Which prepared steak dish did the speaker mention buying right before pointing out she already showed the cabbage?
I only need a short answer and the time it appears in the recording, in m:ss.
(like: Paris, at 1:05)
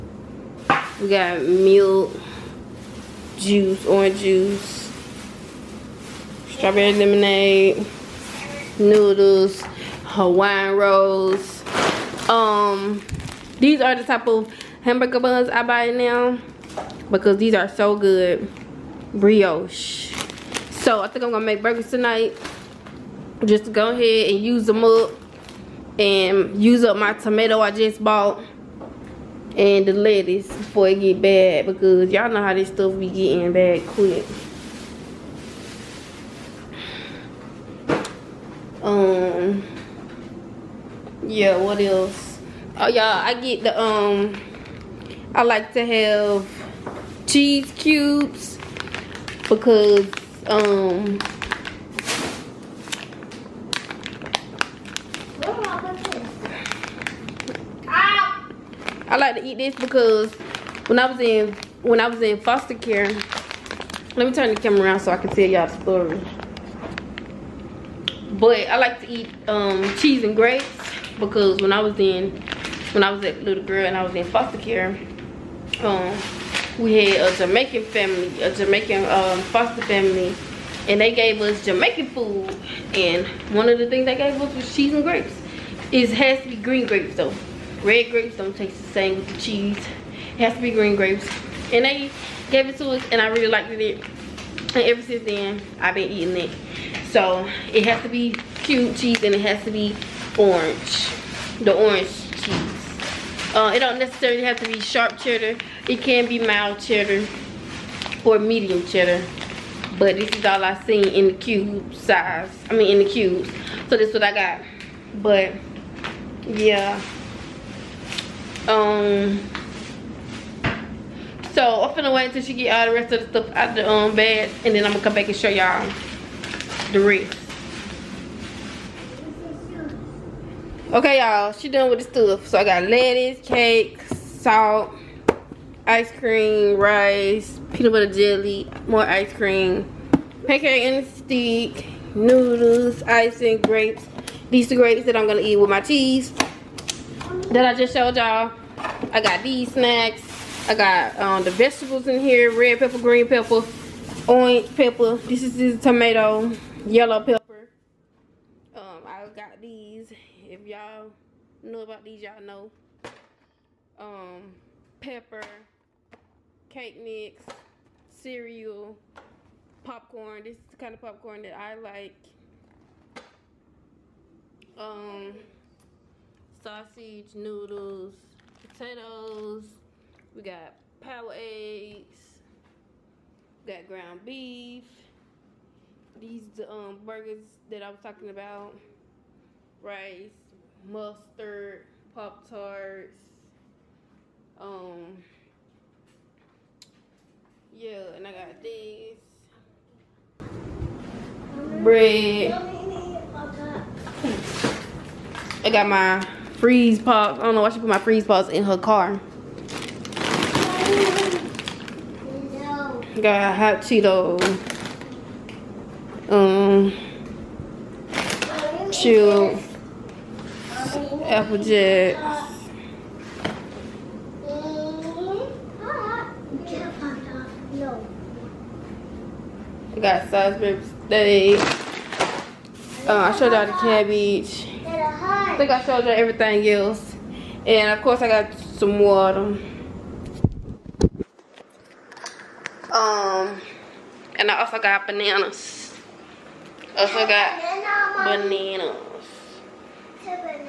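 Salisbury steak, at 3:50.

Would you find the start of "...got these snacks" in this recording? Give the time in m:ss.
2:29.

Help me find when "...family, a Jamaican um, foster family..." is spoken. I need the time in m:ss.
1:17.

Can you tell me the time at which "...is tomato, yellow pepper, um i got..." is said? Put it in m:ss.
2:35.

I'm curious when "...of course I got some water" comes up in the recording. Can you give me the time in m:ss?
3:57.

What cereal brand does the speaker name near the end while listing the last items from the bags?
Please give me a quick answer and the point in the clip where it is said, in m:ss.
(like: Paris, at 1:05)
Applejack, at 3:41.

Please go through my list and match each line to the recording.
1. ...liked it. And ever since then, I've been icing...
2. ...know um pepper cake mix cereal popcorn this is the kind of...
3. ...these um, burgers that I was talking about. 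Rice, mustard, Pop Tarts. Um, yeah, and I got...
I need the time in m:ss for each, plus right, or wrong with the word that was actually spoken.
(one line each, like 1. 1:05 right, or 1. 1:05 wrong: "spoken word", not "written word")
1. 1:33 wrong: "eating", not "icing"
2. 2:42 right
3. 3:06 right.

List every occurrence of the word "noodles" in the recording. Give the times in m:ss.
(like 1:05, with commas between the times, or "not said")
0:08, 2:22, 2:57.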